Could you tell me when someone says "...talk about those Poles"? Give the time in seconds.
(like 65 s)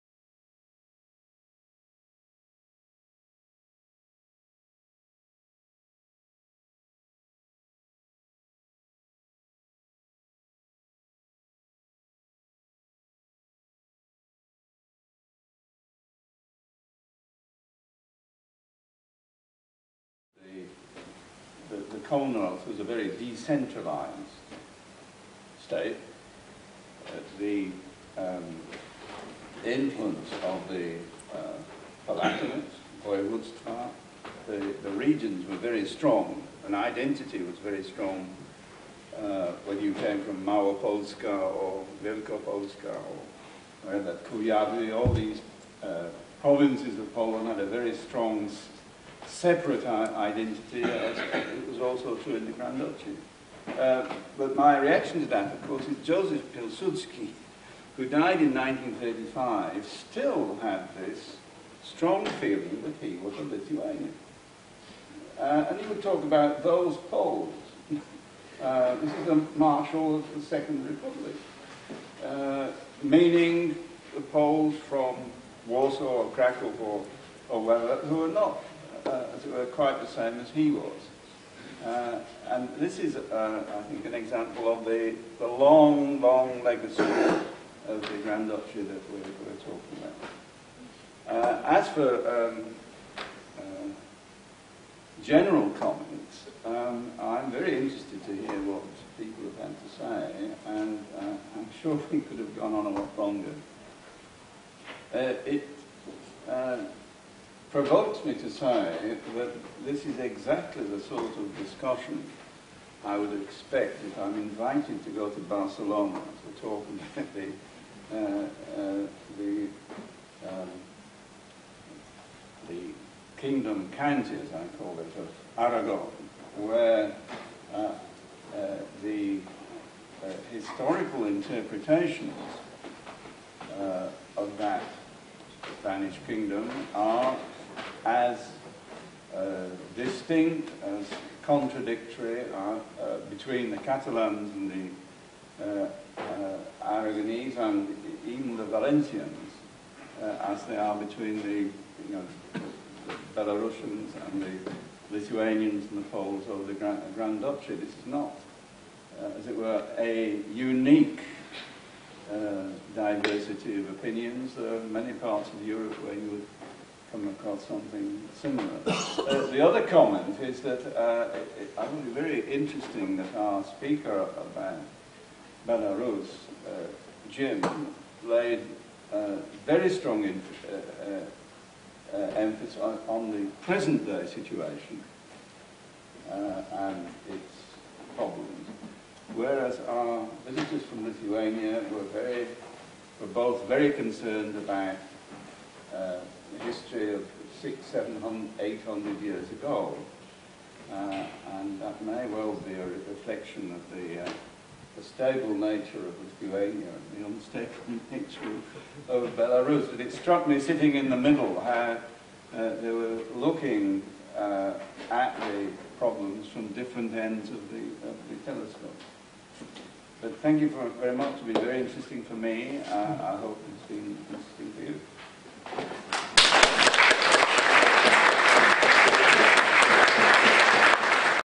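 66 s.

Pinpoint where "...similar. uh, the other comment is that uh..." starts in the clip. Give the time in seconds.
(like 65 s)
168 s.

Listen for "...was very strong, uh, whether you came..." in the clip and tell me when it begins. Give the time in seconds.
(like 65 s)
37 s.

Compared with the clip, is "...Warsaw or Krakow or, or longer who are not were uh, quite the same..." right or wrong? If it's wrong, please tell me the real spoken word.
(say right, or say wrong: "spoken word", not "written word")
wrong: "wherever", not "longer".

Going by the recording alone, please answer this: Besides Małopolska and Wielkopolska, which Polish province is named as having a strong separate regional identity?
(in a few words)
Kujawy.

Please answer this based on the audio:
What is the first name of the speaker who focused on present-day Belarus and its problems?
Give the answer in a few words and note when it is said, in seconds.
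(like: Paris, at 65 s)
Jim, at 177 s.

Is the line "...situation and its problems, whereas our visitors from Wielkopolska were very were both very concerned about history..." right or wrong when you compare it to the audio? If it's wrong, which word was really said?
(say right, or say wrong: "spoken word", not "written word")
wrong: "Lithuania", not "Wielkopolska".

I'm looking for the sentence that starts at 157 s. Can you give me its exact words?
This is not, uh, as it were, a unique diversity of opinions.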